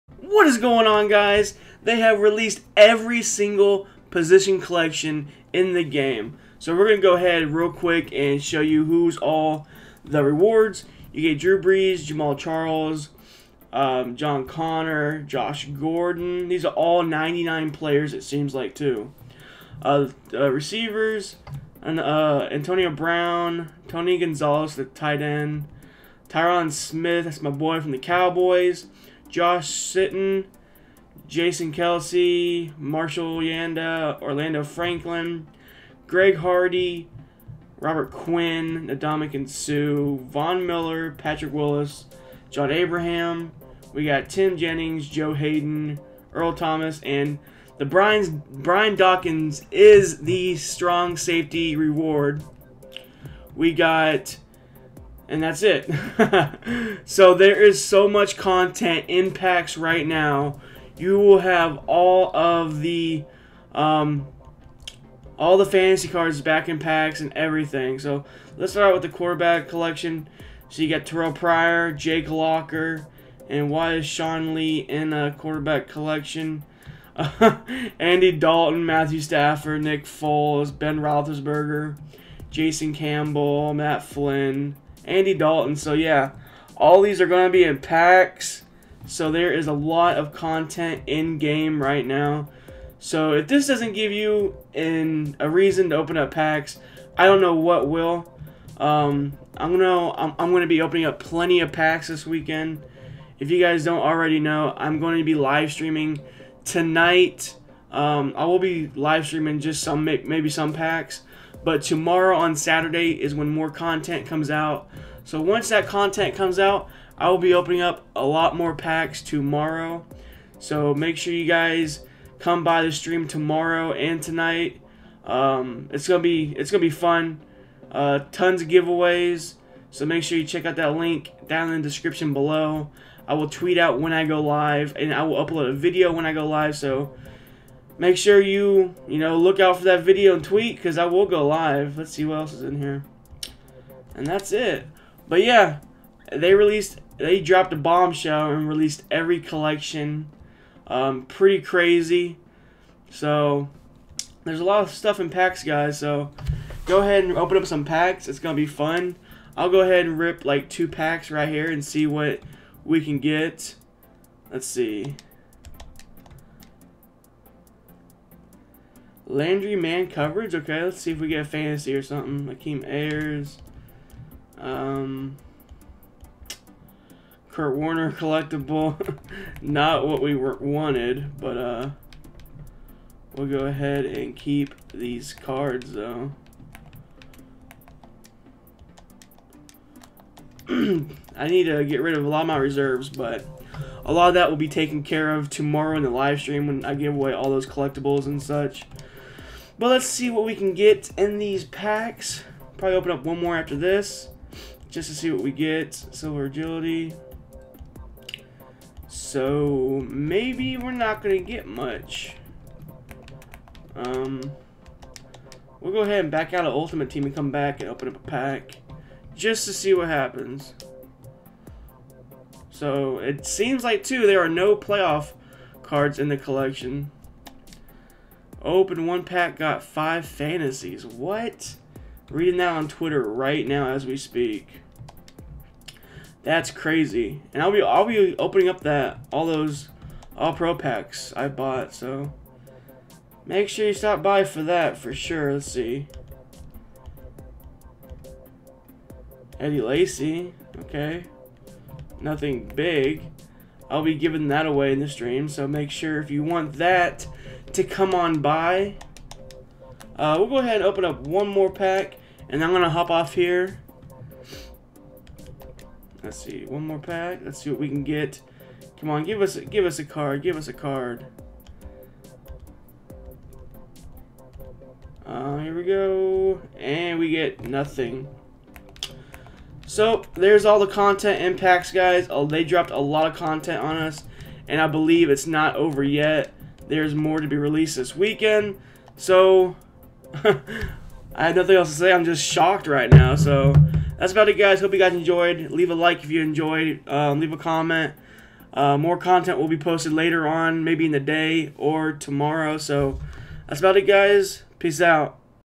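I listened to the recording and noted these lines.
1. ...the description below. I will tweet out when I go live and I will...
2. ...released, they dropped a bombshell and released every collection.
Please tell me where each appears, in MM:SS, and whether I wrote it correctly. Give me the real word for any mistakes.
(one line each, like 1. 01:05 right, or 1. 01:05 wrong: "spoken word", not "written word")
1. 02:11 right
2. 02:26 right.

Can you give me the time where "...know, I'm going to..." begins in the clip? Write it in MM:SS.
01:44.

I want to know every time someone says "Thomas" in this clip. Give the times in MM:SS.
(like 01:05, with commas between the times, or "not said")
00:46.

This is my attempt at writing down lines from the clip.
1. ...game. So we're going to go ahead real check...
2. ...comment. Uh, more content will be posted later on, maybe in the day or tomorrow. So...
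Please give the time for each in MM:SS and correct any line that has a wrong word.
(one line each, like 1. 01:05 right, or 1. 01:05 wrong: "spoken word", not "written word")
1. 00:05 wrong: "quick", not "check"
2. 04:57 right.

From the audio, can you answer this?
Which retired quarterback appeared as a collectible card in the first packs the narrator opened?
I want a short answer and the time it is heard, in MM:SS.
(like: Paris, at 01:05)
Kurt Warner, at 02:57.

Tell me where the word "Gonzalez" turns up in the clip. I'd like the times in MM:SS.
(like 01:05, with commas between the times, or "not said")
00:24.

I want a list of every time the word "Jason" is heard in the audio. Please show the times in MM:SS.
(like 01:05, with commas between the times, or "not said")
00:31, 01:22.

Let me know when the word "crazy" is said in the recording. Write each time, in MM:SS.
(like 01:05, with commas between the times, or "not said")
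02:31, 03:56.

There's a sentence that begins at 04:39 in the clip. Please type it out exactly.
So, there's all the content impacts, guys.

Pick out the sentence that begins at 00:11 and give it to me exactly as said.
You get Drew Brees, Jamaal Charles, um, John Connor, Josh Gordon.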